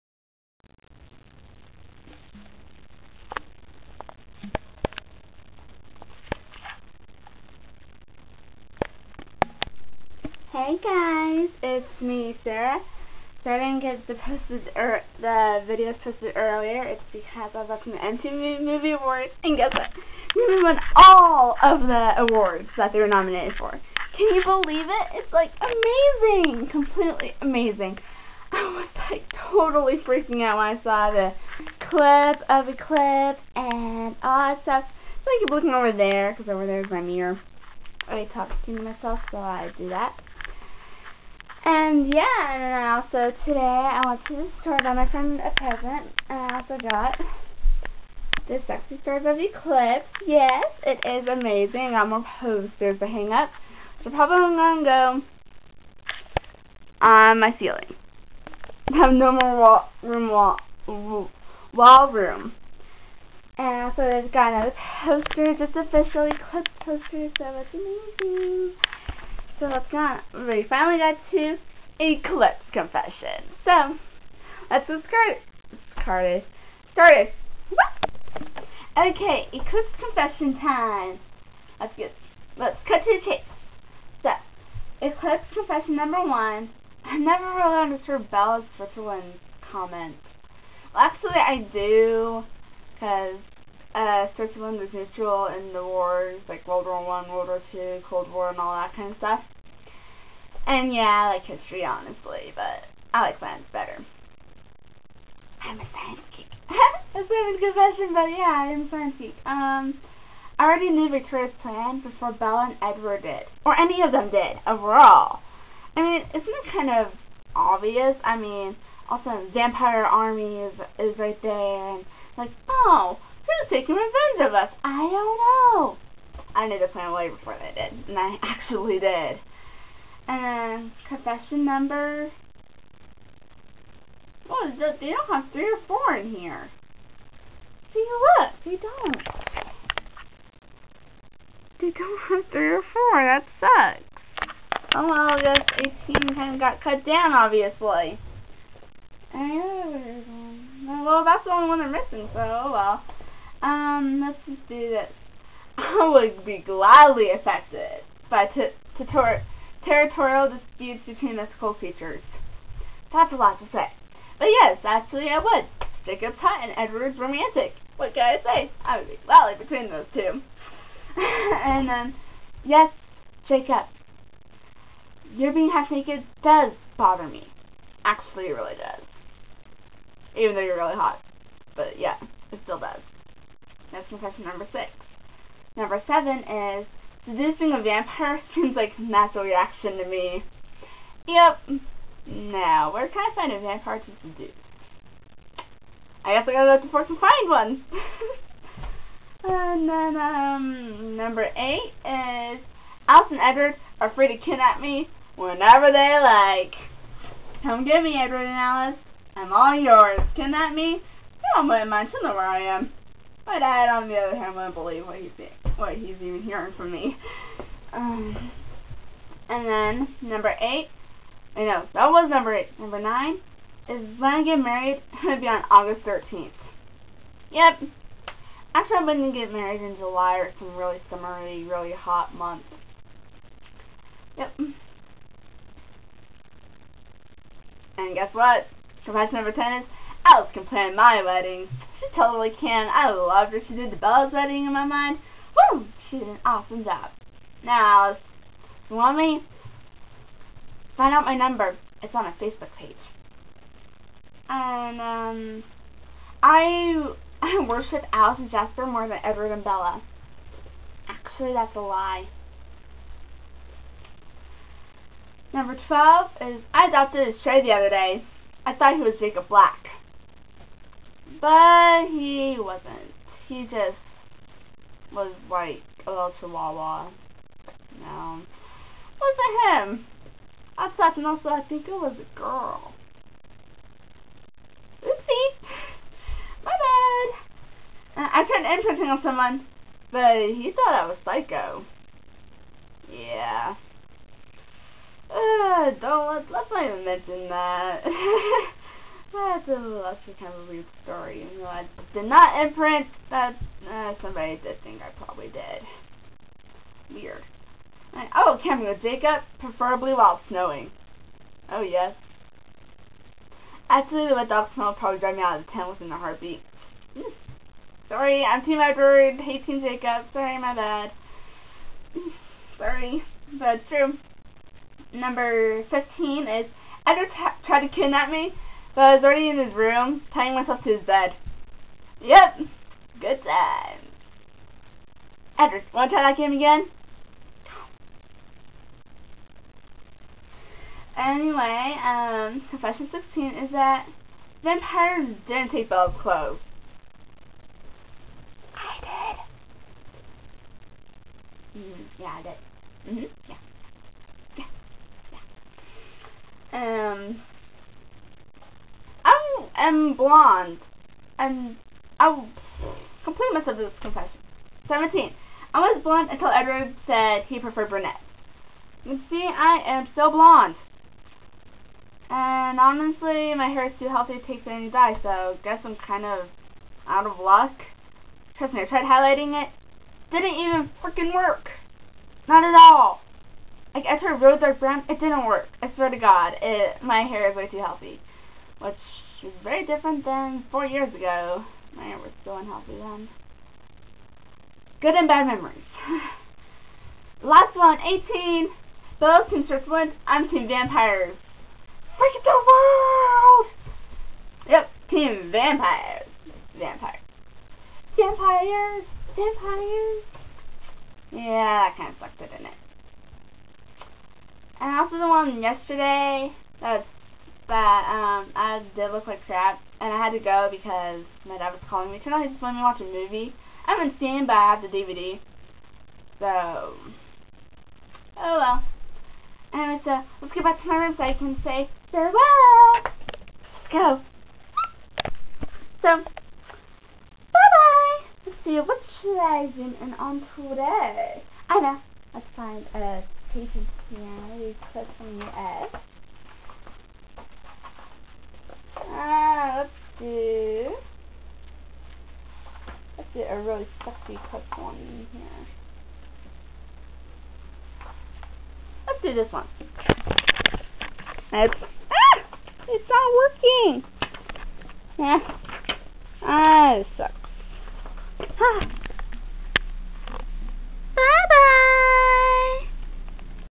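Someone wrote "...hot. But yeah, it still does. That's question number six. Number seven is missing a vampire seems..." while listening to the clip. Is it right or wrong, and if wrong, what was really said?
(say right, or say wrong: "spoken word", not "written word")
wrong: "seducing", not "missing".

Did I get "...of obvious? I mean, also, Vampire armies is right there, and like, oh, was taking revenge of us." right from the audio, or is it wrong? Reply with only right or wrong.
right.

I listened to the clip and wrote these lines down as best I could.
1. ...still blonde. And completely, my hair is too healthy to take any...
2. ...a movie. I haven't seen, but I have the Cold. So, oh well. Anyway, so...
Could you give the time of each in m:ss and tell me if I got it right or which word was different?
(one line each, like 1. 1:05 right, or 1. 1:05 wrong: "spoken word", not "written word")
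1. 6:10 wrong: "honestly", not "completely"
2. 7:02 wrong: "DVD", not "Cold".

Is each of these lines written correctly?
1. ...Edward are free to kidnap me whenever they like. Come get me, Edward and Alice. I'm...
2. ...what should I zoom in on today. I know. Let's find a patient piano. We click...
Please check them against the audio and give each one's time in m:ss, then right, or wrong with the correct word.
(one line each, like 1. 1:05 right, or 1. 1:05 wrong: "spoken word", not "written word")
1. 3:23 right
2. 7:18 right.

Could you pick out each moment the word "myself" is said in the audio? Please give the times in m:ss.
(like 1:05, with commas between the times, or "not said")
0:38, 5:30, 6:03.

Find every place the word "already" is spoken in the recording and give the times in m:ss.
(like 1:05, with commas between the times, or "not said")
1:50, 5:29.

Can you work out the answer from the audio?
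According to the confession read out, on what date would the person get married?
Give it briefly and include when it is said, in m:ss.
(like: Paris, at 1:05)
August 13th, at 3:45.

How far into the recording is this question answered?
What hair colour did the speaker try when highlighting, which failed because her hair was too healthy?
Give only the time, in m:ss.
6:24.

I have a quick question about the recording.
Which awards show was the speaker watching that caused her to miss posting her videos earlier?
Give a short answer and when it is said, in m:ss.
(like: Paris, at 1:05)
MTV Movie Awards, at 0:17.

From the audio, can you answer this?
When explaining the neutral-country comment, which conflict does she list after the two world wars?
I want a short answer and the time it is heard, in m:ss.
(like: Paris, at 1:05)
Cold War, at 1:38.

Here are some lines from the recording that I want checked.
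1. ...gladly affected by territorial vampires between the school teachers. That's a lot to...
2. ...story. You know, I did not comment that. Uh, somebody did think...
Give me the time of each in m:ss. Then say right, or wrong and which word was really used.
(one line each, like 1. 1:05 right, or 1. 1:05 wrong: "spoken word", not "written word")
1. 2:36 wrong: "disputes", not "vampires"
2. 5:01 wrong: "imprint", not "comment".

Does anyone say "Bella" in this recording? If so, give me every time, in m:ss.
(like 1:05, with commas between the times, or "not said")
1:28, 1:52, 4:03, 4:19.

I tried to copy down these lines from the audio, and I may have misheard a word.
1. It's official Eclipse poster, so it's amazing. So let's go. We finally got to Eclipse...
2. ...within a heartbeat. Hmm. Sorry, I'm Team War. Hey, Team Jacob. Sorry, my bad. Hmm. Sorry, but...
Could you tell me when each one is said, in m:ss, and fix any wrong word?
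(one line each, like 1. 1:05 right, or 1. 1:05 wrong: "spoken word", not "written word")
1. 1:05 right
2. 5:15 wrong: "Edward", not "War".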